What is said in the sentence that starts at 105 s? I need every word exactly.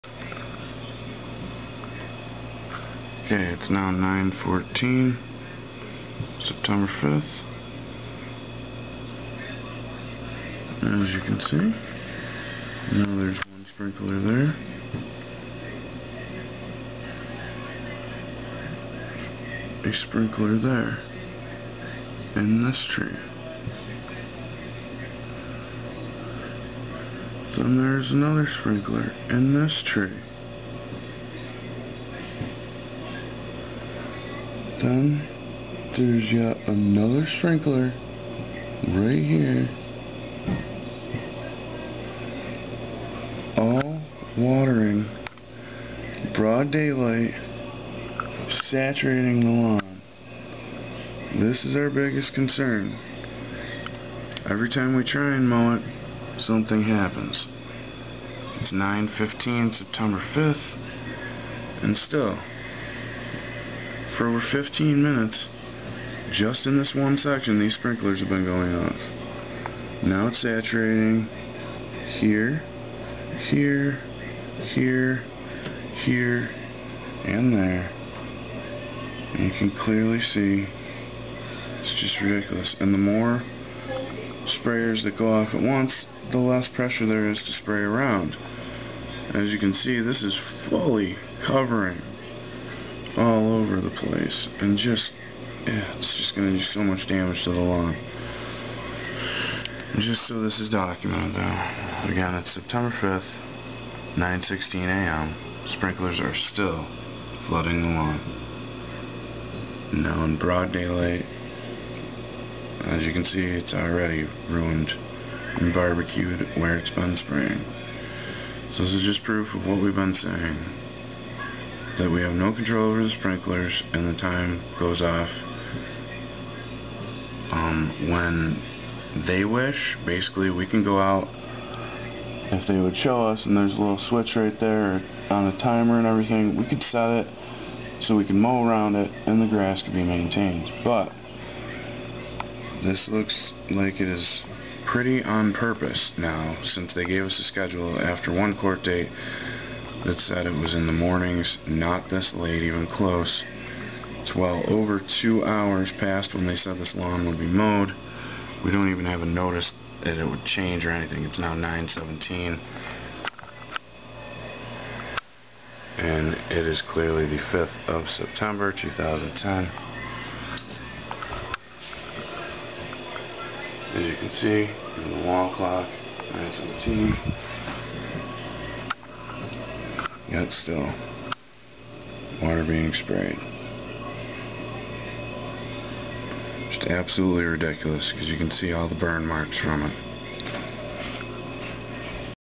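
Sprinklers are still flooding the lawn.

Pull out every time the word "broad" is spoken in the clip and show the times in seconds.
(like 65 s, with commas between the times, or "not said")
46 s, 110 s.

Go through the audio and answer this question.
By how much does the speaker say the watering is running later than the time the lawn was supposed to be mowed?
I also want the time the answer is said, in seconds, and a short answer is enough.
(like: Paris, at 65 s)
over 2 hours, at 154 s.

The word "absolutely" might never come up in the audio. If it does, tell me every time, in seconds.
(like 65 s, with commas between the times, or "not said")
186 s.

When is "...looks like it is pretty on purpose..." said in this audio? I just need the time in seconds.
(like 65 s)
143 s.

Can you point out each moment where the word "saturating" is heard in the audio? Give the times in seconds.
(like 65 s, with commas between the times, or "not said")
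48 s, 70 s.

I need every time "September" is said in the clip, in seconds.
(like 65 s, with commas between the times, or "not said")
6 s, 59 s, 102 s, 168 s.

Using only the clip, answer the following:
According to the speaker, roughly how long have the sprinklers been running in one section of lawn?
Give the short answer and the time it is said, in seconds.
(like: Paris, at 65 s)
over 15 minutes, at 64 s.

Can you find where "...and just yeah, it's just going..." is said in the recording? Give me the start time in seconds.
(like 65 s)
94 s.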